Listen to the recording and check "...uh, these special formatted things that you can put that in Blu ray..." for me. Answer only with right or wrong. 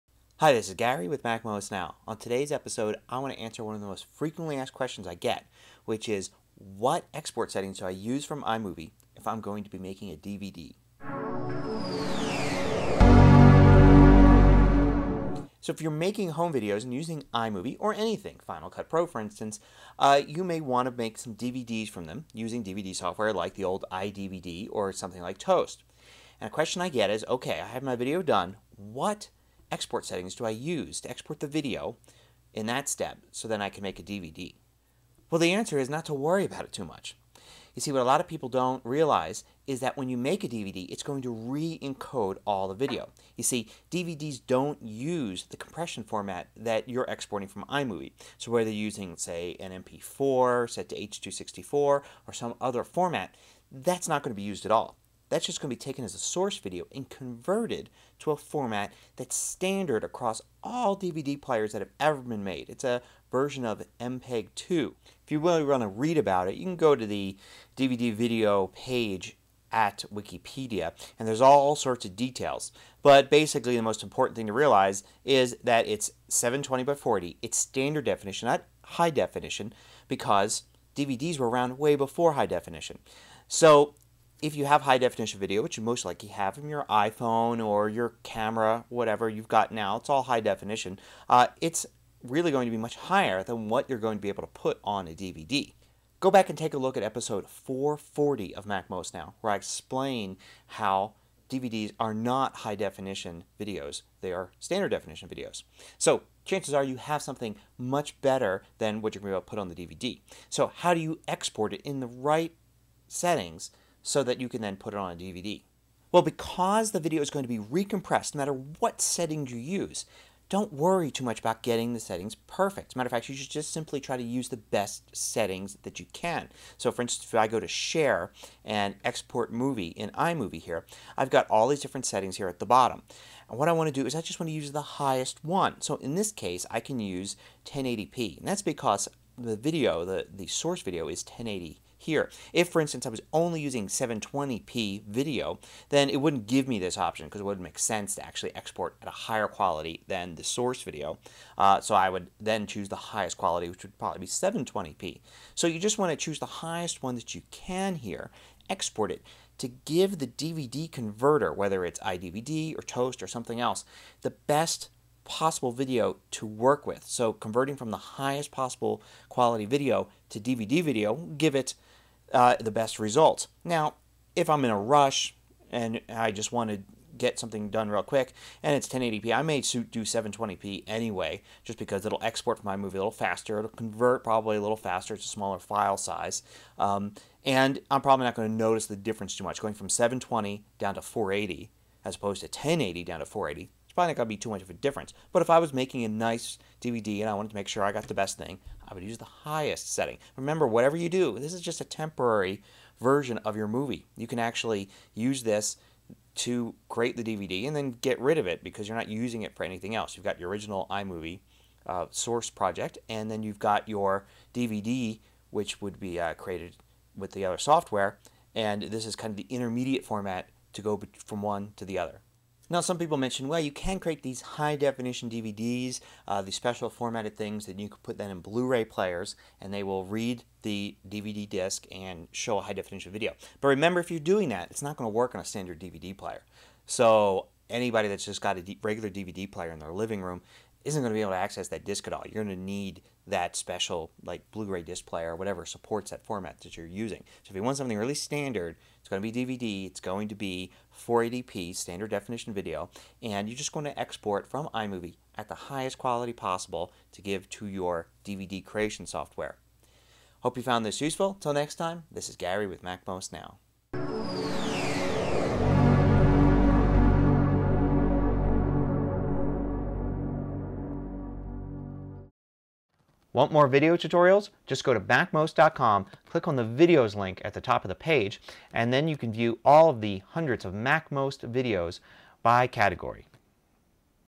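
right.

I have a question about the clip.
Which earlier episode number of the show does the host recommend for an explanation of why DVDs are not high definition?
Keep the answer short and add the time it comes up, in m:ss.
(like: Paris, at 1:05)
440, at 1:37.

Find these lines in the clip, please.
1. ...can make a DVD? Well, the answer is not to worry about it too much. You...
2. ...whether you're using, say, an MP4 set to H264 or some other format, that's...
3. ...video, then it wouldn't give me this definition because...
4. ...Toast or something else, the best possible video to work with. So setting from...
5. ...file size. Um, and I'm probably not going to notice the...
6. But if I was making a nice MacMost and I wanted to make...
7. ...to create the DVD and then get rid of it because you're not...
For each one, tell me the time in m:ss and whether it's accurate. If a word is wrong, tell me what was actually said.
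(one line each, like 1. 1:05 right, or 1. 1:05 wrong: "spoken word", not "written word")
1. 0:33 right
2. 0:48 right
3. 2:25 wrong: "option", not "definition"
4. 2:42 wrong: "converting", not "setting"
5. 3:05 right
6. 3:15 wrong: "DVD", not "MacMost"
7. 3:26 right.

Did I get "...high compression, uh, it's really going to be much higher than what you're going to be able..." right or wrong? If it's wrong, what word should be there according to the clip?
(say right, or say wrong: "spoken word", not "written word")
wrong: "definition", not "compression".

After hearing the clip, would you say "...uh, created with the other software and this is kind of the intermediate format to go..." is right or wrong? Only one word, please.
right.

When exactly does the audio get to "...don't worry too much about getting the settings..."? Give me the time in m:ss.
2:00.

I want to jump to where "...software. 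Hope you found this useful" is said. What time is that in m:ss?
4:19.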